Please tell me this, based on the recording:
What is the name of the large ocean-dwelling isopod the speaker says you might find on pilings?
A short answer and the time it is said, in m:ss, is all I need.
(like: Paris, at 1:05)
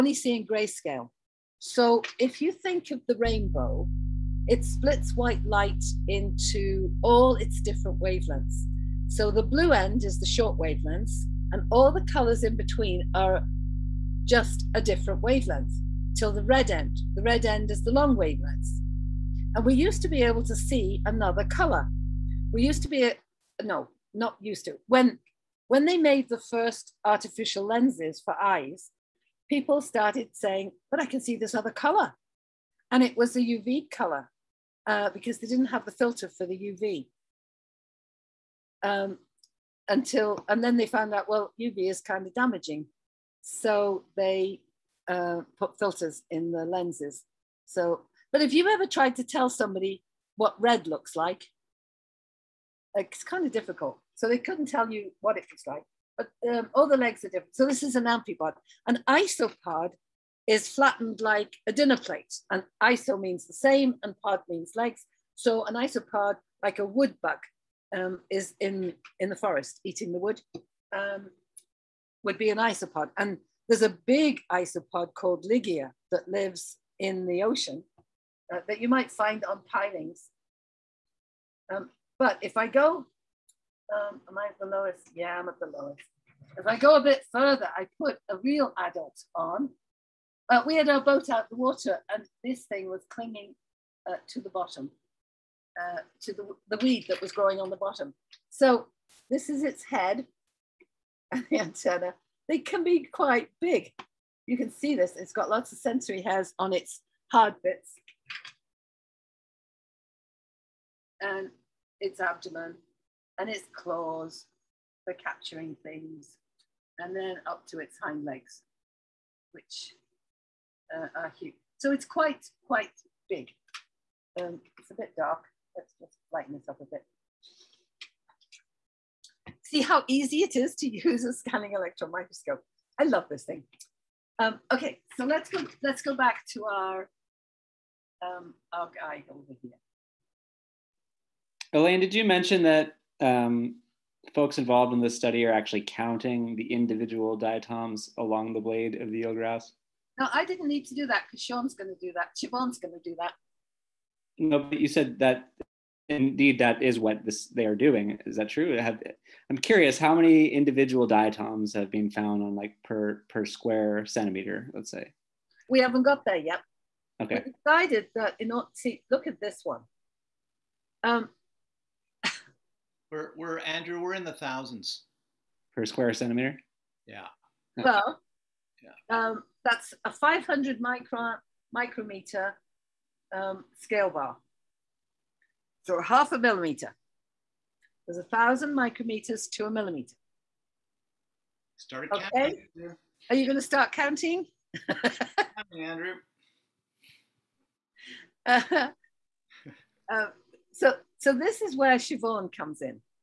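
Ligia, at 1:15.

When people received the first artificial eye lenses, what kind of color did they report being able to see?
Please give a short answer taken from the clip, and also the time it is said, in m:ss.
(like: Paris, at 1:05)
UV color, at 0:33.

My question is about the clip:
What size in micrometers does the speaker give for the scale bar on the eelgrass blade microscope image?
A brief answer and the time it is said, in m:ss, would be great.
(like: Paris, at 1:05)
500, at 3:00.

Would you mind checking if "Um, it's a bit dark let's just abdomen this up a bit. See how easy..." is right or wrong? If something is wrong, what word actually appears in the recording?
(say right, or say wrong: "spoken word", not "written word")
wrong: "lighten", not "abdomen".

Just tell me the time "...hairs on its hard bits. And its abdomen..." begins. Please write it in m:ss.
1:46.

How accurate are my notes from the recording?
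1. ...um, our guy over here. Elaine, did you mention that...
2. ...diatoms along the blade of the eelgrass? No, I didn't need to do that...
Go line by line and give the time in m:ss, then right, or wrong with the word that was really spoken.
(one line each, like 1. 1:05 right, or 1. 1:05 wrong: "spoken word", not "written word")
1. 2:18 right
2. 2:27 right.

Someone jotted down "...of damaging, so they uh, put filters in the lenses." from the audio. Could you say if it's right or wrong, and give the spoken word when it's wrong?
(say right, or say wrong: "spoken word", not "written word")
right.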